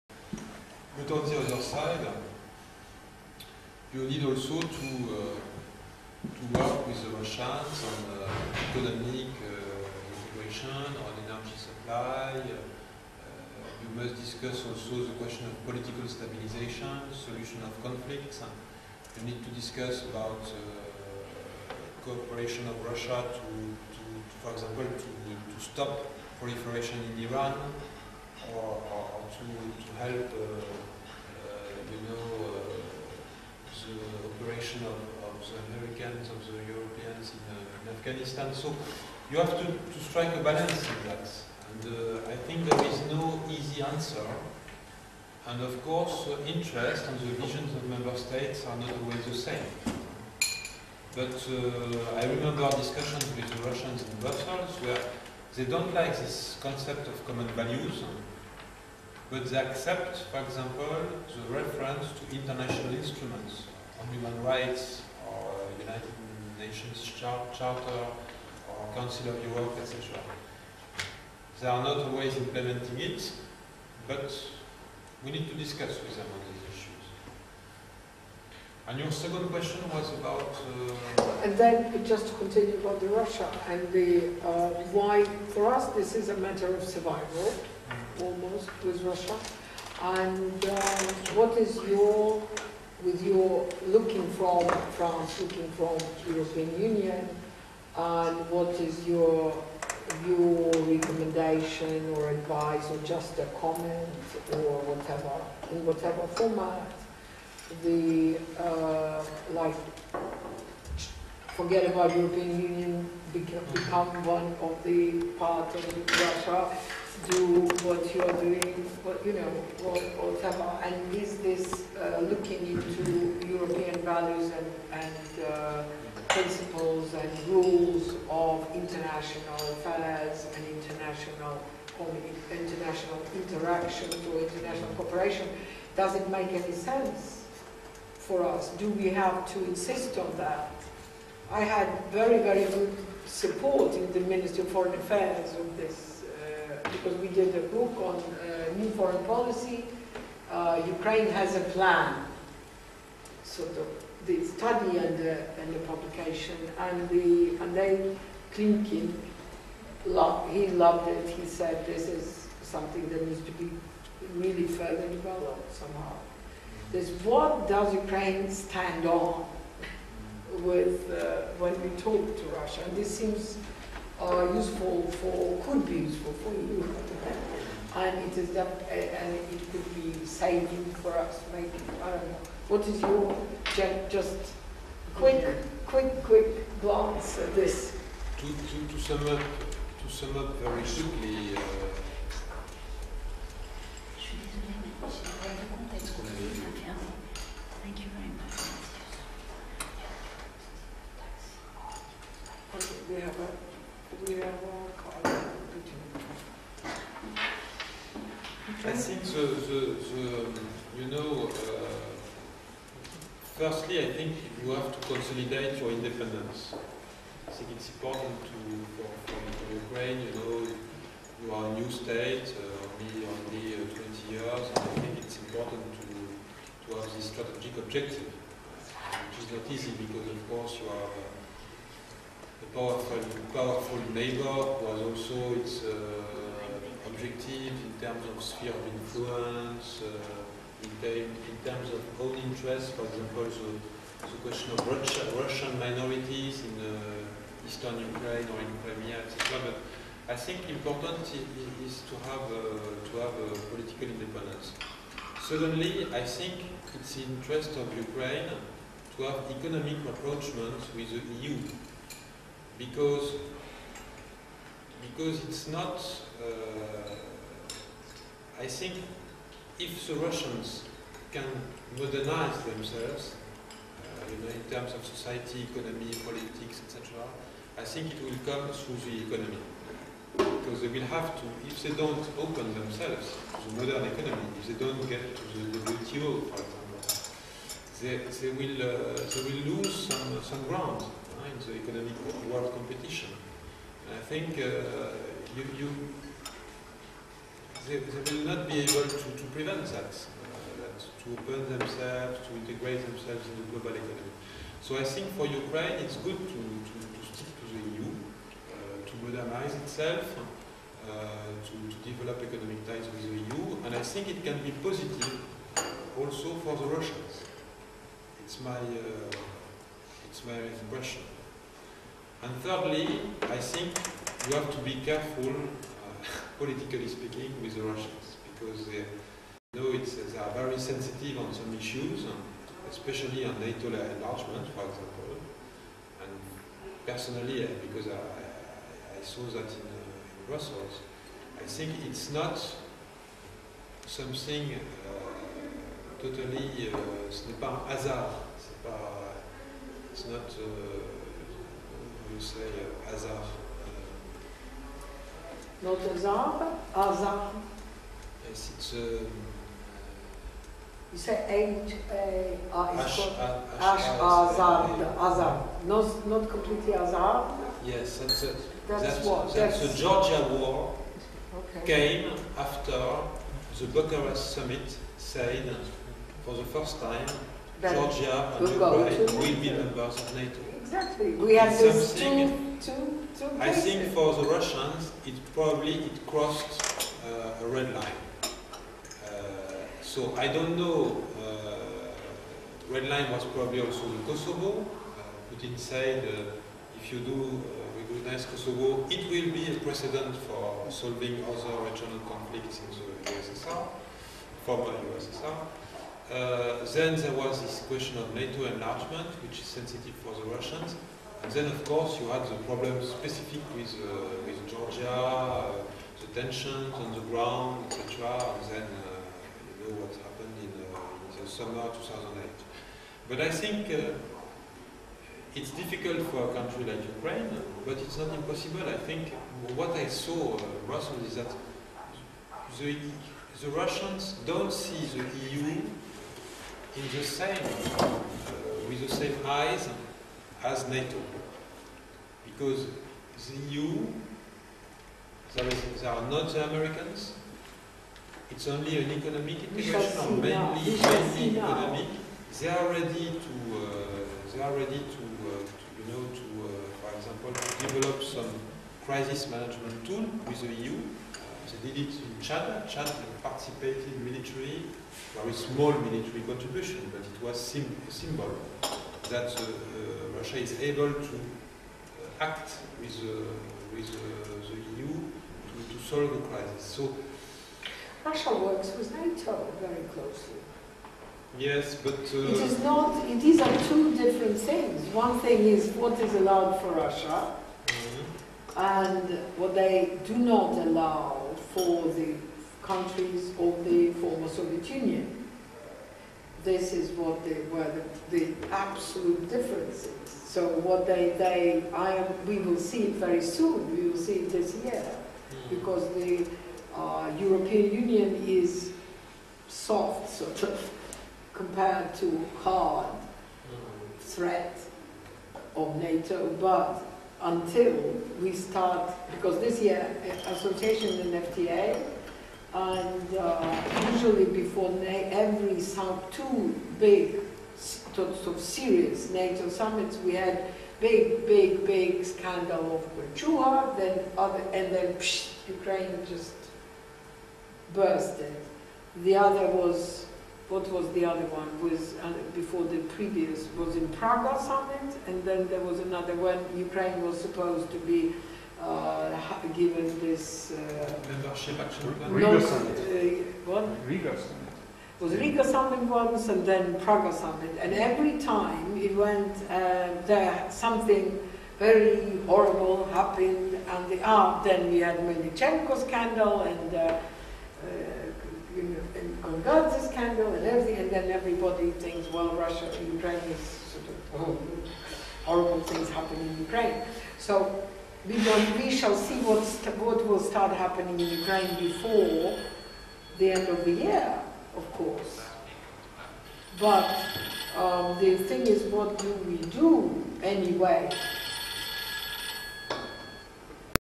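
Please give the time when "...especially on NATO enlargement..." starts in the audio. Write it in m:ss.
5:32.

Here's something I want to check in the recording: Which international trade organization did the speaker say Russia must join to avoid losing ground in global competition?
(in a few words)
WTO.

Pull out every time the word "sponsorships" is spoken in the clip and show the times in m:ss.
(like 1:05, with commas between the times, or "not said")
not said.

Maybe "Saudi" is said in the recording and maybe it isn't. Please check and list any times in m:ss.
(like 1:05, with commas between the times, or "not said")
not said.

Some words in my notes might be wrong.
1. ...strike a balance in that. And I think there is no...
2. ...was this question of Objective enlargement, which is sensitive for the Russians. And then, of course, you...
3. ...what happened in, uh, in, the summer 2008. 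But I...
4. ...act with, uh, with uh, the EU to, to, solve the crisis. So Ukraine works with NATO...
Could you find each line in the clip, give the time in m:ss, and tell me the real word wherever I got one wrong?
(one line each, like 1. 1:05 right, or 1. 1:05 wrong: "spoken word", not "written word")
1. 0:39 right
2. 6:47 wrong: "NATO", not "Objective"
3. 7:00 right
4. 7:52 wrong: "Russia", not "Ukraine".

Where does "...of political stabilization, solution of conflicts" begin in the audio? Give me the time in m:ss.
0:15.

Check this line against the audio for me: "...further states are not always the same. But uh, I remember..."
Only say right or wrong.
wrong.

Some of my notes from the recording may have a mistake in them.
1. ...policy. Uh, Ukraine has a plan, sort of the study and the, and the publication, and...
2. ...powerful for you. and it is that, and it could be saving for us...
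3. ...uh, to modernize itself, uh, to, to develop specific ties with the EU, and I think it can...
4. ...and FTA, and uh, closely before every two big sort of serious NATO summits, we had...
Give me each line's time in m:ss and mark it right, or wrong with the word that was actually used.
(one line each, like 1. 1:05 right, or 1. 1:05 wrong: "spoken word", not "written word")
1. 2:29 right
2. 2:56 wrong: "useful", not "powerful"
3. 5:08 wrong: "economic", not "specific"
4. 8:41 wrong: "usually", not "closely".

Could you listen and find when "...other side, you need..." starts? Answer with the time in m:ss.
0:01.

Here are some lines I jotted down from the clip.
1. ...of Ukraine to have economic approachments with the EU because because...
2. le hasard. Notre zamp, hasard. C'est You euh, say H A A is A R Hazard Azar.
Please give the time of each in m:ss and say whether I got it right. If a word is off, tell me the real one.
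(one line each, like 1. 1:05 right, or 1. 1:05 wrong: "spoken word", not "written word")
1. 4:17 right
2. 5:52 right.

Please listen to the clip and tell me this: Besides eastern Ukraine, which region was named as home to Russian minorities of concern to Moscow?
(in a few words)
Crimea.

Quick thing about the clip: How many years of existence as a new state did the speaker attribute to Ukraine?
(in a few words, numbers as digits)
20.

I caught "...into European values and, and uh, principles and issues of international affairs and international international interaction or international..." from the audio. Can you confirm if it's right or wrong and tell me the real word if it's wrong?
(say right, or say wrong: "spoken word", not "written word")
wrong: "rules", not "issues".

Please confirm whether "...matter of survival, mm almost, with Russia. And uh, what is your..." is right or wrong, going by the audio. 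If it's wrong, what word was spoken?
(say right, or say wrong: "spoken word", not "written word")
right.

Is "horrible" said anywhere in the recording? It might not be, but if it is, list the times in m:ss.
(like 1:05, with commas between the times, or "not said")
9:22, 9:35.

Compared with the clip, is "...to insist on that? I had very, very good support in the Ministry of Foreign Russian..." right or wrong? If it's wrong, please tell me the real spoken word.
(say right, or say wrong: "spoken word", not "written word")
wrong: "Affairs", not "Russian".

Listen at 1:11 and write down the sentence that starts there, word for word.
They are not always implementing it, but we need to discuss with them on this issue.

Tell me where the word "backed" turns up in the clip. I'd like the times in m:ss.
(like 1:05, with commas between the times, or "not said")
not said.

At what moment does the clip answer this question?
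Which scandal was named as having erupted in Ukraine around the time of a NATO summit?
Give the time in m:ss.
9:25.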